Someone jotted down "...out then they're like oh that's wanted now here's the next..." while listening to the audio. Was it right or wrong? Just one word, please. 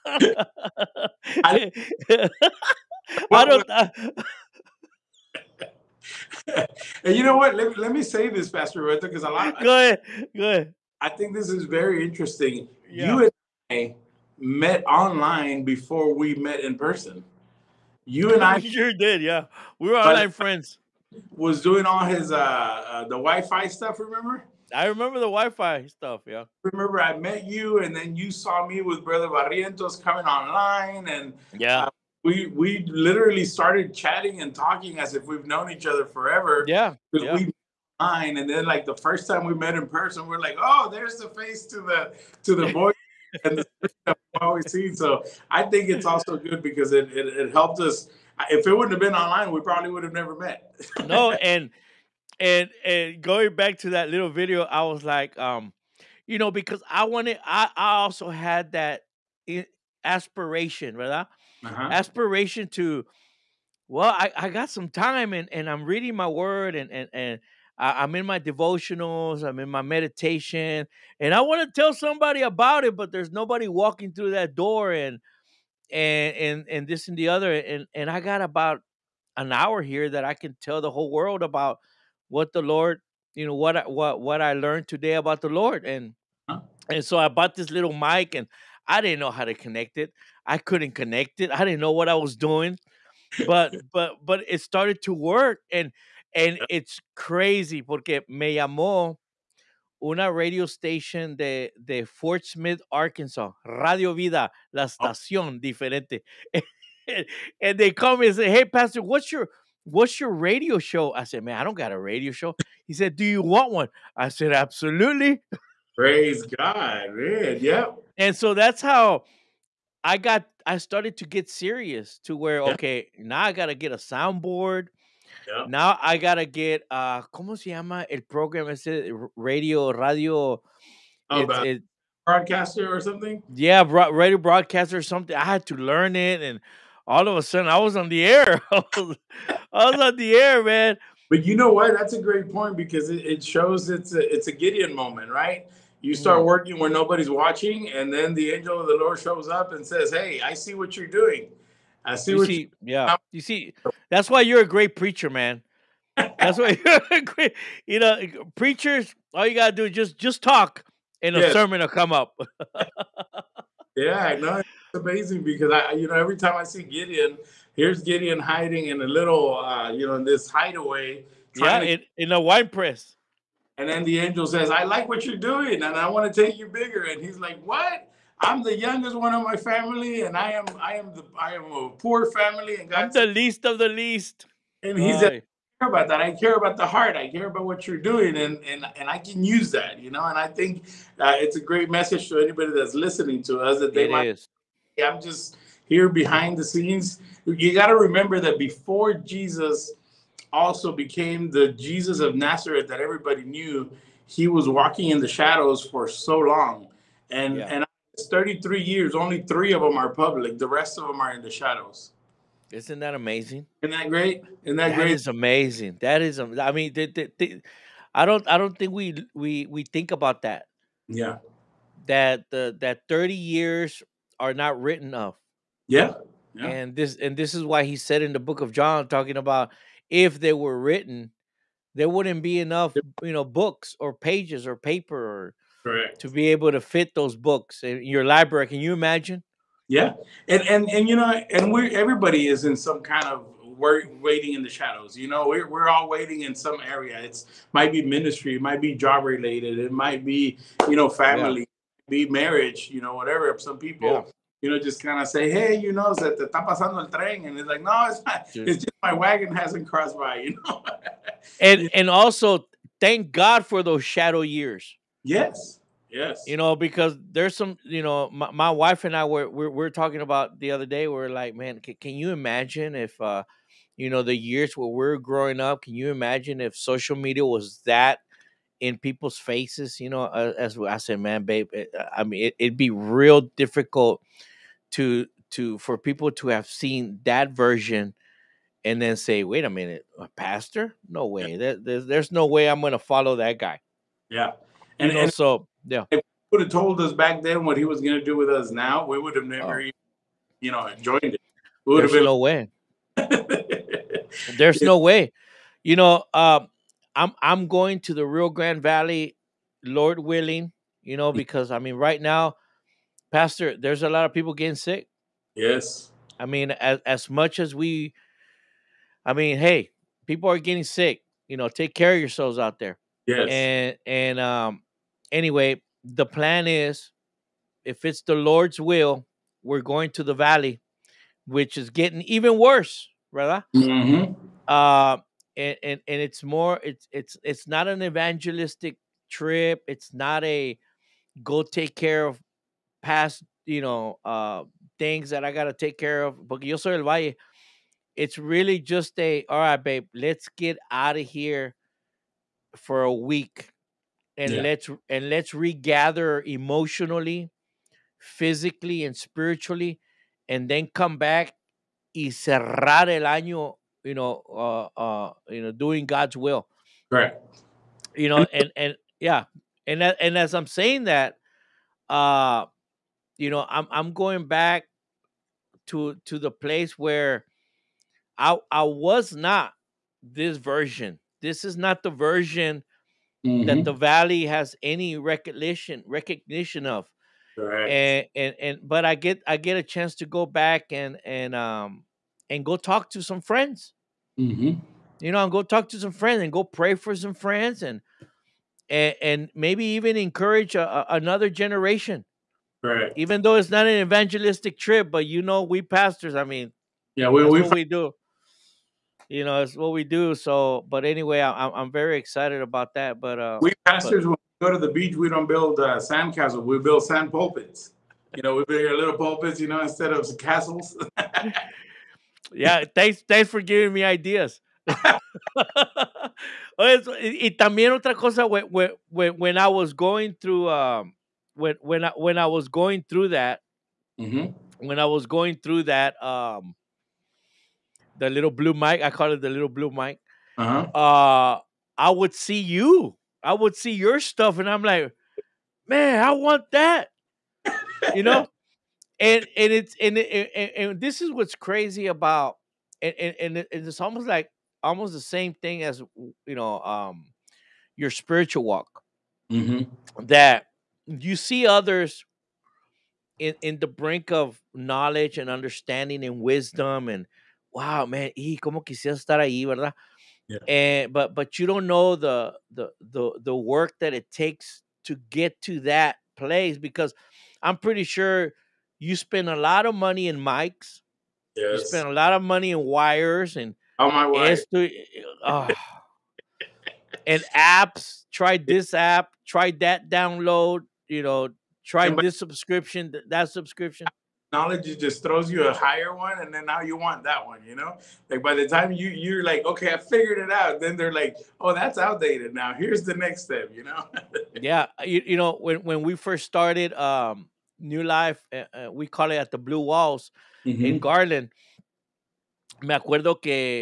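wrong.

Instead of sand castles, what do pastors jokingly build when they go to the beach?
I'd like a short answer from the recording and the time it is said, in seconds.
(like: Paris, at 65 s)
sand pulpits, at 417 s.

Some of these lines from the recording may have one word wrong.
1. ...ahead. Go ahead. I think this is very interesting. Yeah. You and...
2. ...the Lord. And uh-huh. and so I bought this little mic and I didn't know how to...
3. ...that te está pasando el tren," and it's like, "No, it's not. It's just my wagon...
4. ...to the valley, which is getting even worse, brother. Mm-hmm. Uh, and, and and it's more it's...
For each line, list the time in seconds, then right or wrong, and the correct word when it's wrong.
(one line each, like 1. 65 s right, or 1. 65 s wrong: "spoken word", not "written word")
1. 9 s right
2. 85 s right
3. 256 s right
4. 330 s right.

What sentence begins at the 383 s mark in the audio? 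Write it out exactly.
that the valley has any recognition recognition of.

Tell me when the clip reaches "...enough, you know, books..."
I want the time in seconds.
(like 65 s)
232 s.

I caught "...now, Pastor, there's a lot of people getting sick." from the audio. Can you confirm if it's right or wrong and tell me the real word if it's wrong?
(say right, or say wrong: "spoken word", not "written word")
right.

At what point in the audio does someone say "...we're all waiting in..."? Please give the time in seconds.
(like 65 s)
245 s.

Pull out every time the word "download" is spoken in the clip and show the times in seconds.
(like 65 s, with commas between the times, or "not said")
490 s.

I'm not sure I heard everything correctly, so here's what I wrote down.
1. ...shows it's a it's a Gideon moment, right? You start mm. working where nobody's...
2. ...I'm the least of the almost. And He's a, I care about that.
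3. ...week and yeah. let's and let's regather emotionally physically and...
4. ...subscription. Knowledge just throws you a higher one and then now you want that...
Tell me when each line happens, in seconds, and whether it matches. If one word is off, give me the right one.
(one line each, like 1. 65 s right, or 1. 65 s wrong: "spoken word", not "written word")
1. 143 s right
2. 183 s wrong: "least", not "almost"
3. 353 s right
4. 493 s right.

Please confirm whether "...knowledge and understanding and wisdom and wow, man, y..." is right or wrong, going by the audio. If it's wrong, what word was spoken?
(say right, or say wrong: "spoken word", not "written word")
right.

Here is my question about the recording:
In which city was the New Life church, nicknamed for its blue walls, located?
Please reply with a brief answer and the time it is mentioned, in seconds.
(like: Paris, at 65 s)
Garland, at 511 s.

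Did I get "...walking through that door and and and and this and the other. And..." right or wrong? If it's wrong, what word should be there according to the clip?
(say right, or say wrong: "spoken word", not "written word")
right.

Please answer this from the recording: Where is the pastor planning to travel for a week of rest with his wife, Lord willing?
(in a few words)
Rio Grande Valley.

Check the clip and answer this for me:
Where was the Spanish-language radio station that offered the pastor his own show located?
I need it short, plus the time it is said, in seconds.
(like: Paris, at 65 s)
Fort Smith, Arkansas, at 102 s.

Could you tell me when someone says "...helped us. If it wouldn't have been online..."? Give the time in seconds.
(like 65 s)
47 s.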